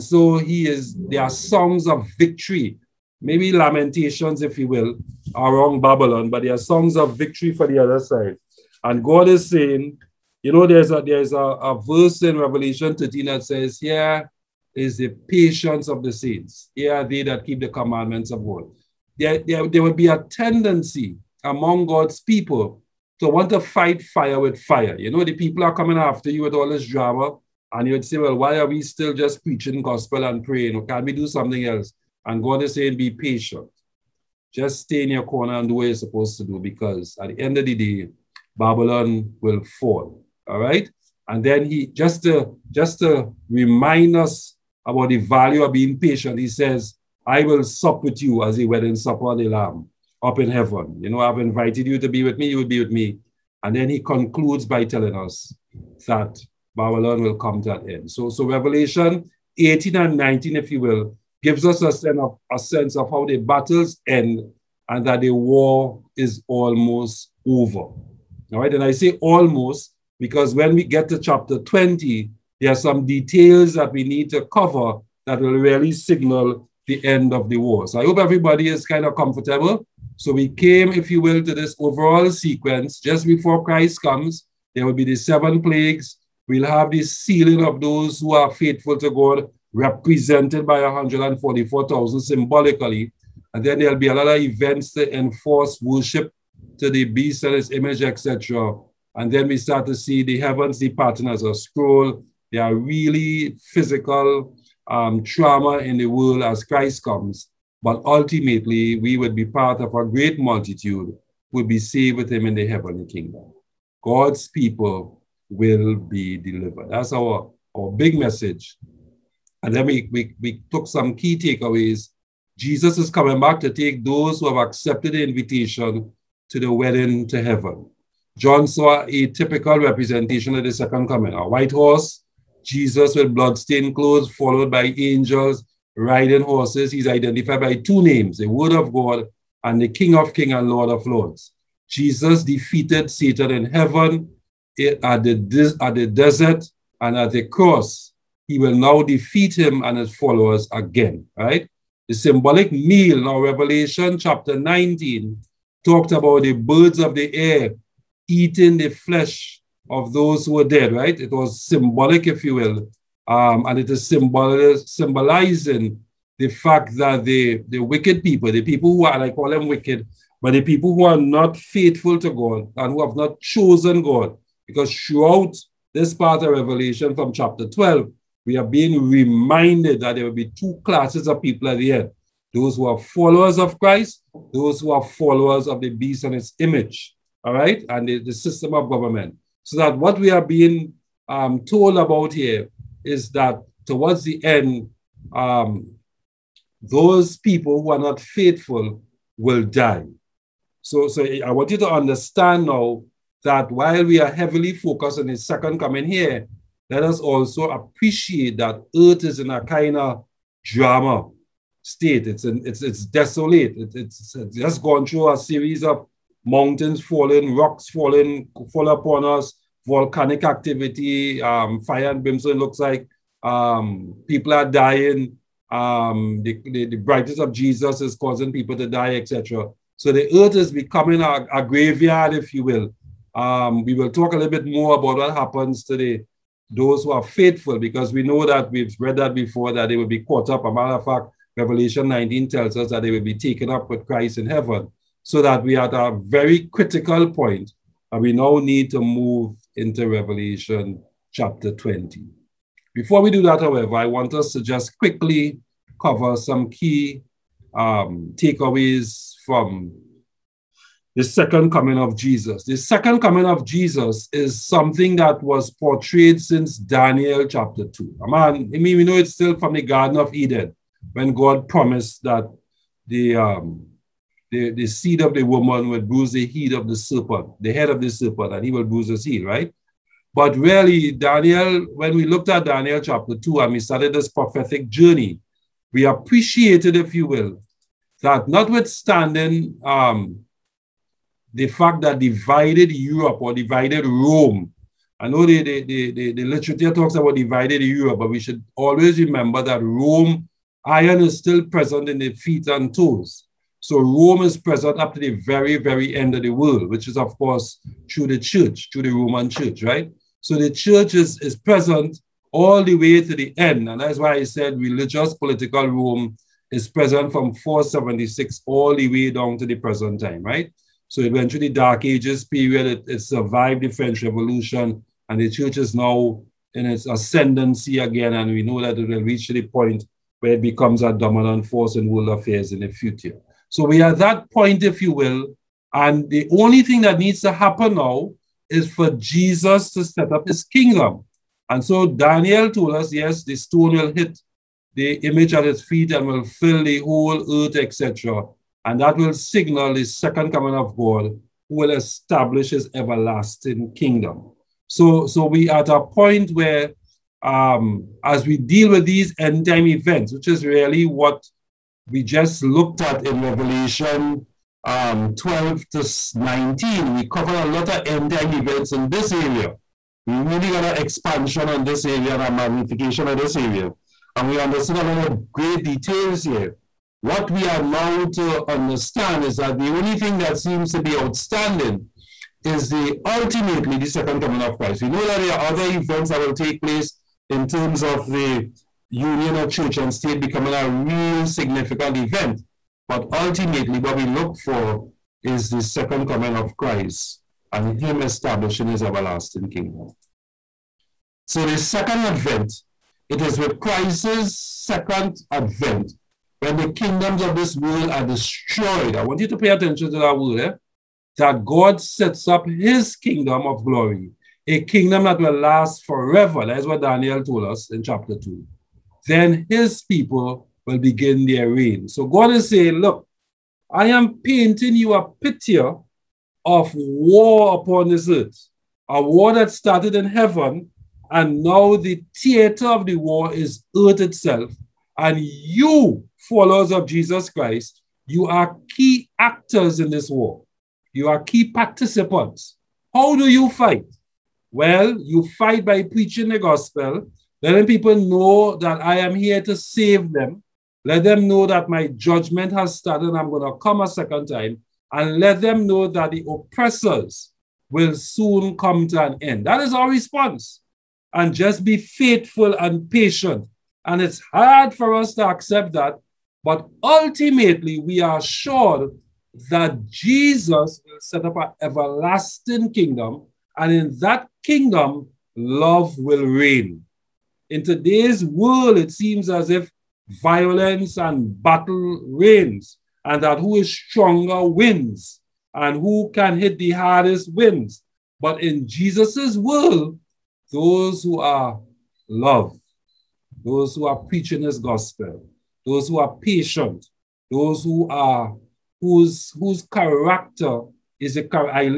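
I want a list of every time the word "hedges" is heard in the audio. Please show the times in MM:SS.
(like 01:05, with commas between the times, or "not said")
not said.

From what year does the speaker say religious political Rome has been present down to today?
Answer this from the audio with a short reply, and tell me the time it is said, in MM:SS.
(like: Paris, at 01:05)
476, at 05:17.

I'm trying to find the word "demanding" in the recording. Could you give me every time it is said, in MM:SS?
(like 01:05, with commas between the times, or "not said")
not said.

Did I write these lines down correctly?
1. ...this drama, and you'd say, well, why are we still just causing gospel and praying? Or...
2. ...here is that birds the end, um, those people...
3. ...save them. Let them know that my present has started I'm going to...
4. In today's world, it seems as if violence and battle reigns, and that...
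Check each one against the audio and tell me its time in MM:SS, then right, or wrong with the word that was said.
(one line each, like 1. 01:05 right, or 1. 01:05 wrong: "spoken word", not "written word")
1. 00:26 wrong: "preaching", not "causing"
2. 03:12 wrong: "towards", not "birds"
3. 07:29 wrong: "judgment", not "present"
4. 07:57 right.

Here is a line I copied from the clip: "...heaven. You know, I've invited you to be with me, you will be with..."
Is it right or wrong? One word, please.
right.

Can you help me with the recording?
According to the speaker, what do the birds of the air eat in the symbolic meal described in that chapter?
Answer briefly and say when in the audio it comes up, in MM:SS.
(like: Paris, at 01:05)
the flesh of those who were dead, at 02:38.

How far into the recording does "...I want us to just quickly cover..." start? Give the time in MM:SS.
04:13.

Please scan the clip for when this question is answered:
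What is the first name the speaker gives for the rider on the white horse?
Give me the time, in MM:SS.
02:18.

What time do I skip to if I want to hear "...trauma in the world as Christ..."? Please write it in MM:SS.
01:45.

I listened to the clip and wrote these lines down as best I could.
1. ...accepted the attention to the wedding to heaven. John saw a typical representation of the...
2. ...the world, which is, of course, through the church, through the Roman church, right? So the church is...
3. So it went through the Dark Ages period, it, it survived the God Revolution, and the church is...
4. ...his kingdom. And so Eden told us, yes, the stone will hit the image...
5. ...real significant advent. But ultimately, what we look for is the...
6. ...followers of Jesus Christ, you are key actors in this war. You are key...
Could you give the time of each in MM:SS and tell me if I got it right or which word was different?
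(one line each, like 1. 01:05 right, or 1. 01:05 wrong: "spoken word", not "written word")
1. 02:04 wrong: "invitation", not "attention"
2. 05:06 right
3. 05:21 wrong: "French", not "God"
4. 05:40 wrong: "Daniel", not "Eden"
5. 06:30 wrong: "event", not "advent"
6. 07:16 right.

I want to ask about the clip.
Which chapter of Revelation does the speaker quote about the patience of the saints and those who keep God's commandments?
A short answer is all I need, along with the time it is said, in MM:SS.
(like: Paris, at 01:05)
Revelation 13, at 00:12.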